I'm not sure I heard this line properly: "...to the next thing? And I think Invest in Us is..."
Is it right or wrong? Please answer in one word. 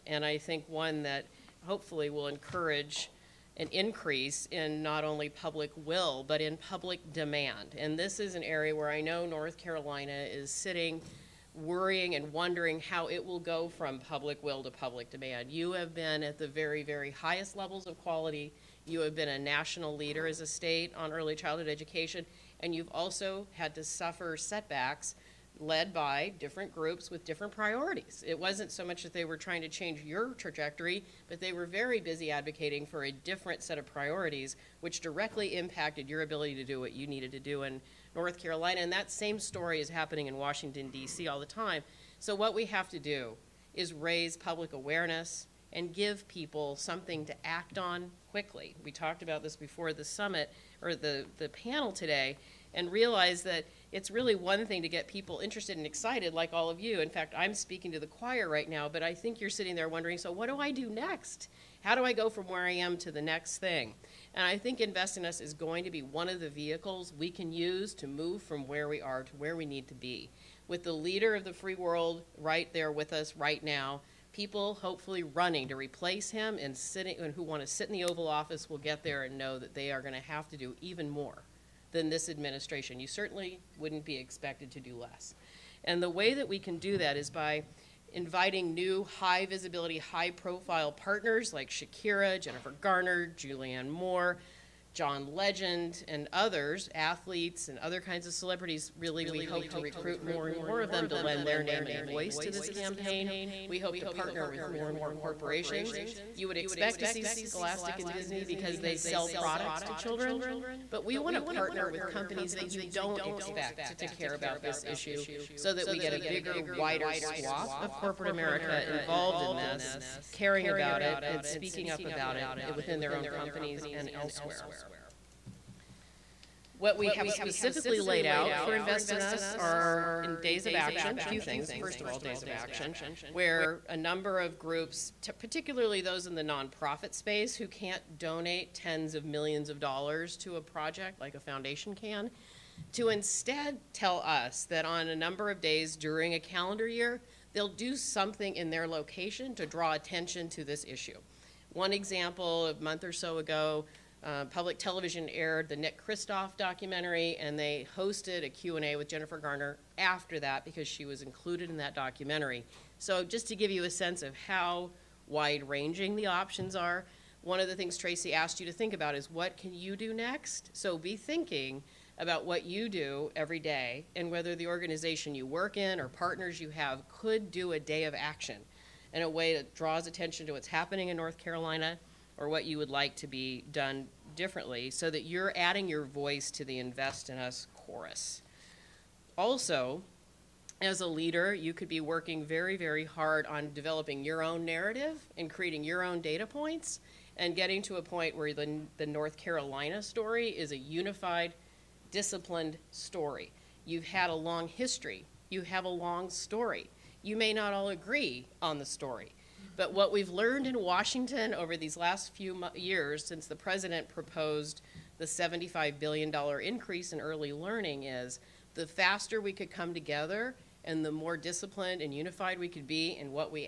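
right.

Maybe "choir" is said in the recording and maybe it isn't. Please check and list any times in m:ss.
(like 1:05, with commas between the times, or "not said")
0:58.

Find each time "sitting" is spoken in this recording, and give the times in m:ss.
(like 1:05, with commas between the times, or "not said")
0:10, 0:59, 1:16.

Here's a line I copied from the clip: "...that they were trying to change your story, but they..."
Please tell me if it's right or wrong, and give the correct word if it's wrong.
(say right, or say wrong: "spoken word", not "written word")
wrong: "trajectory", not "story".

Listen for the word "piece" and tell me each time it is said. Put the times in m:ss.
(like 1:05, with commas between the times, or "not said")
not said.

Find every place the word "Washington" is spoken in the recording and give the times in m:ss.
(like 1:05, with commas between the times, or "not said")
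0:40, 3:30.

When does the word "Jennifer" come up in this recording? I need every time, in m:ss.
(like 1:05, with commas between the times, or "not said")
1:32, 2:39.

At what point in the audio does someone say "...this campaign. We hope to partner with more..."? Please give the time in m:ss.
1:42.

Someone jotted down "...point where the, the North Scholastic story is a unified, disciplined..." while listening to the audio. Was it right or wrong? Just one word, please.
wrong.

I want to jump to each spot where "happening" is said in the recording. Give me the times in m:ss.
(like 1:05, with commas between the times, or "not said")
0:39, 3:00.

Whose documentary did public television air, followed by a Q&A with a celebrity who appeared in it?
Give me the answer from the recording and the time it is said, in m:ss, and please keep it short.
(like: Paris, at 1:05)
Nick Kristof, at 2:35.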